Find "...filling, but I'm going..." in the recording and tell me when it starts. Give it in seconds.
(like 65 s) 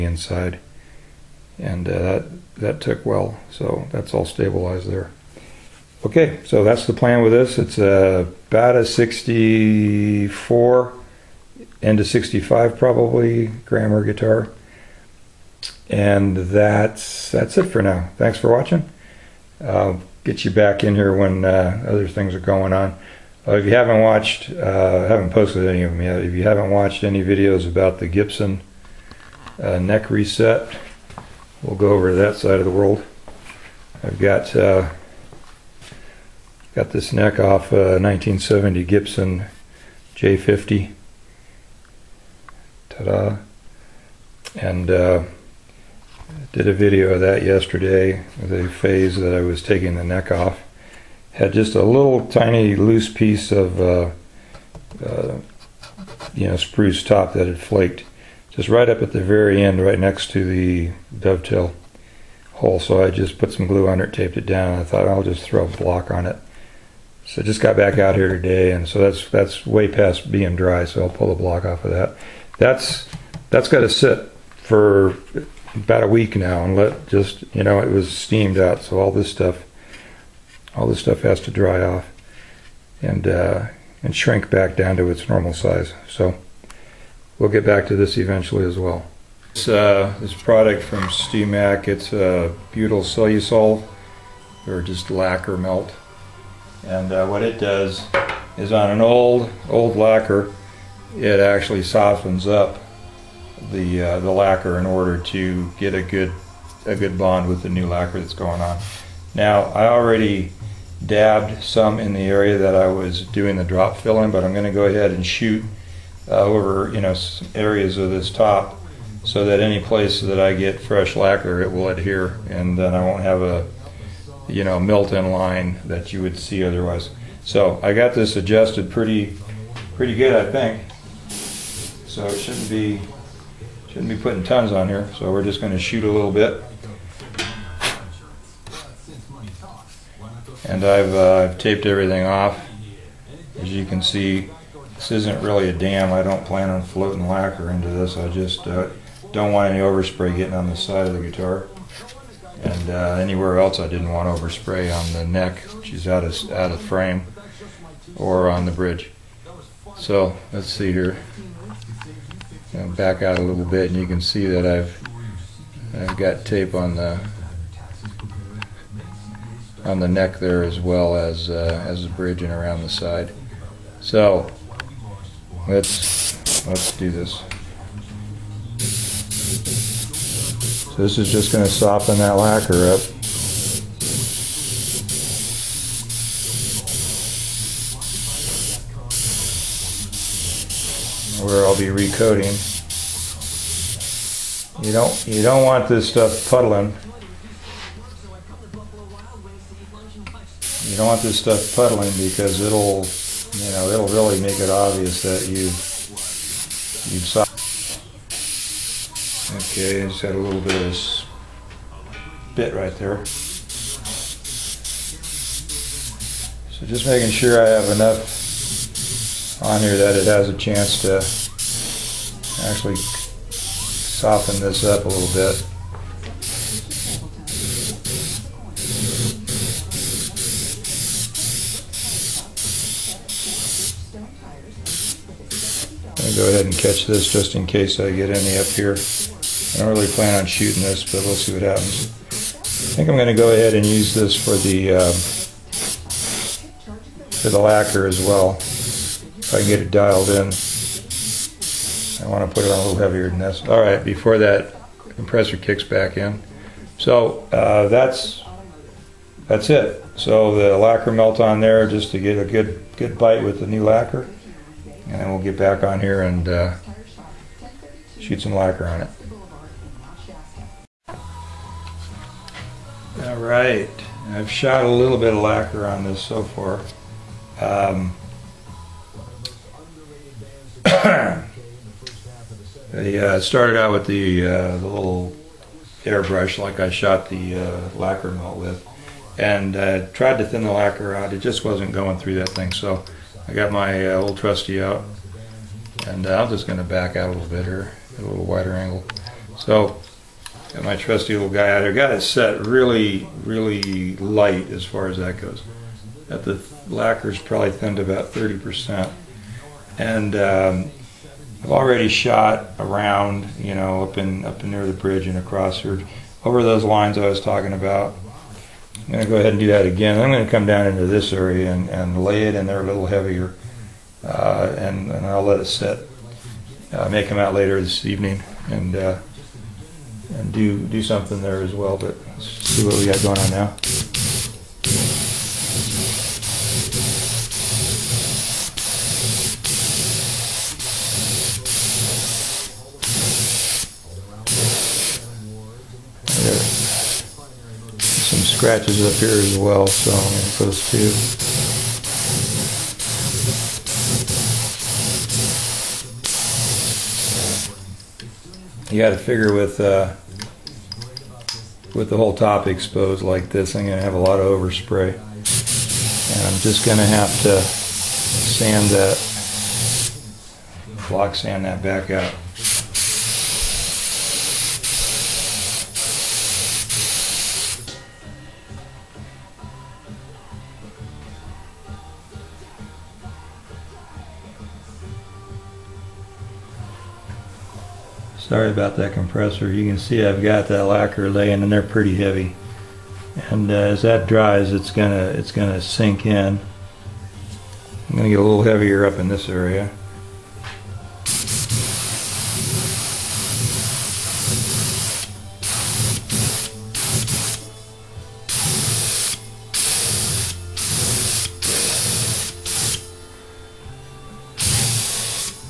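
113 s.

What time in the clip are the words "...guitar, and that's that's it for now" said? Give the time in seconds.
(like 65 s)
14 s.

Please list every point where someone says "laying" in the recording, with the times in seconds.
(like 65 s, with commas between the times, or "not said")
391 s.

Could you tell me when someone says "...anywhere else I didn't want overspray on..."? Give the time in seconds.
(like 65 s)
153 s.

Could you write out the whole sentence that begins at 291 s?
It just wasn't going through that thing.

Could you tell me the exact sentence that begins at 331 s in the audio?
But let's see what we got going on now.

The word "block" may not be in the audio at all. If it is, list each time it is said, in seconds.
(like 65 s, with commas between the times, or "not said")
65 s, 71 s, 371 s.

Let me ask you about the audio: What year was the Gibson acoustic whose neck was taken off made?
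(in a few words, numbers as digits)
1970.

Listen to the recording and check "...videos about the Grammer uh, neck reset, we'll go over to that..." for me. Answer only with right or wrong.
wrong.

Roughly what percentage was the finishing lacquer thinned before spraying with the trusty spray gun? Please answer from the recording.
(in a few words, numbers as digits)
30%.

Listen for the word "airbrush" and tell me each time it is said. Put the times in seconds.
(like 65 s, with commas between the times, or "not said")
286 s.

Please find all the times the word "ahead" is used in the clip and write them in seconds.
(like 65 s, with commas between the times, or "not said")
114 s, 236 s, 243 s, 319 s.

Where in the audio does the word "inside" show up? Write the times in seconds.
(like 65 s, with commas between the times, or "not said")
0 s.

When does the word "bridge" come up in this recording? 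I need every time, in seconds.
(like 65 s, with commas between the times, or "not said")
158 s, 172 s, 314 s.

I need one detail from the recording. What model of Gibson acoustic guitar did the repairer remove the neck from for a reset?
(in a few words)
J50.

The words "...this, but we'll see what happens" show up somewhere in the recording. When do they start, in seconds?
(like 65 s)
240 s.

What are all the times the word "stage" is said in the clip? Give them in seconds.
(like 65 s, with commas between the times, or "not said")
not said.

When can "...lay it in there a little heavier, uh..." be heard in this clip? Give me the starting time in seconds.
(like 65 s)
322 s.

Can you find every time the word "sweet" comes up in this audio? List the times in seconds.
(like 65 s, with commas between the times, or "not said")
not said.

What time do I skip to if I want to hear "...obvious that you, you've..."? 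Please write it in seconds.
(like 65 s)
204 s.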